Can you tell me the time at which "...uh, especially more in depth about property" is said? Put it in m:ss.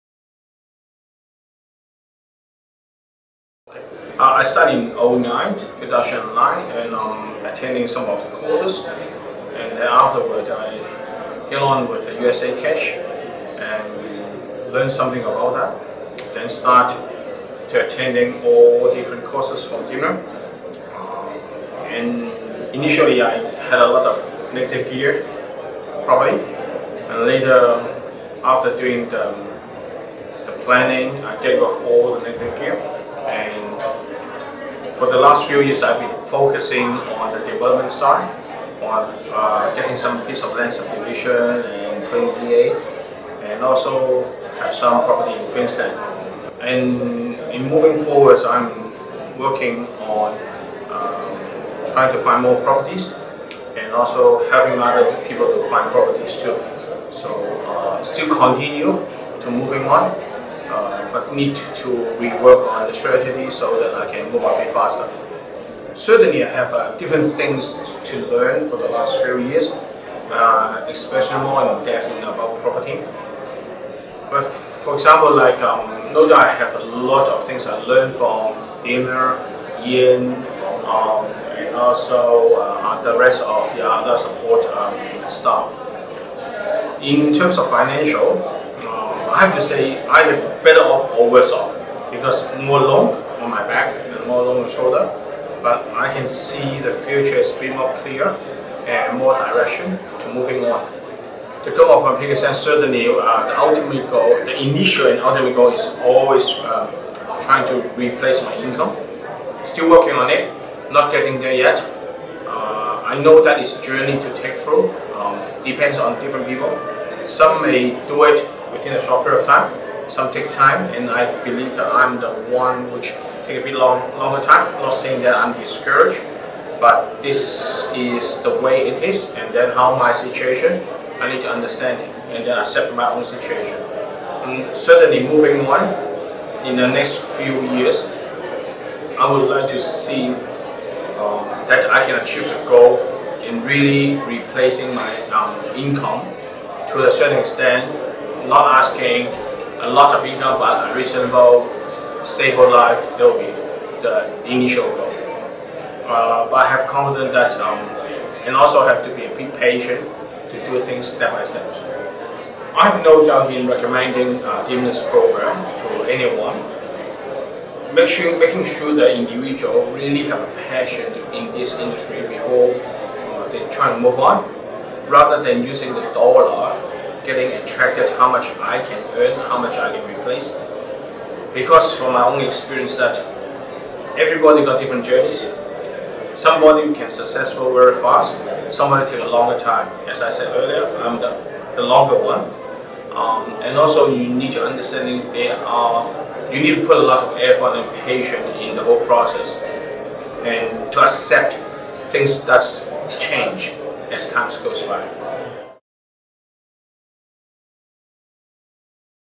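1:09.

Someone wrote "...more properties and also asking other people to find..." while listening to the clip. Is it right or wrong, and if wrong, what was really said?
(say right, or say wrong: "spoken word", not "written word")
wrong: "helping", not "asking".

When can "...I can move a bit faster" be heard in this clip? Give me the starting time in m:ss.
1:03.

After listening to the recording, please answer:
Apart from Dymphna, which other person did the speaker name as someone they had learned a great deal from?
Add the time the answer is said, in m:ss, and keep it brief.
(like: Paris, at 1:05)
Ian, at 1:19.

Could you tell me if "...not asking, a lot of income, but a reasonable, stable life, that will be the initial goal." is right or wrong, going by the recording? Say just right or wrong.
right.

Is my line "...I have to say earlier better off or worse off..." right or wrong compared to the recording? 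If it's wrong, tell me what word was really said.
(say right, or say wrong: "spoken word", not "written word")
wrong: "either", not "earlier".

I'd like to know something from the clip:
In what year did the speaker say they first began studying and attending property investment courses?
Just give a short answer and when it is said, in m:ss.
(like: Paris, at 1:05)
2009, at 0:05.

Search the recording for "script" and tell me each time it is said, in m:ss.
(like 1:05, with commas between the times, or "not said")
not said.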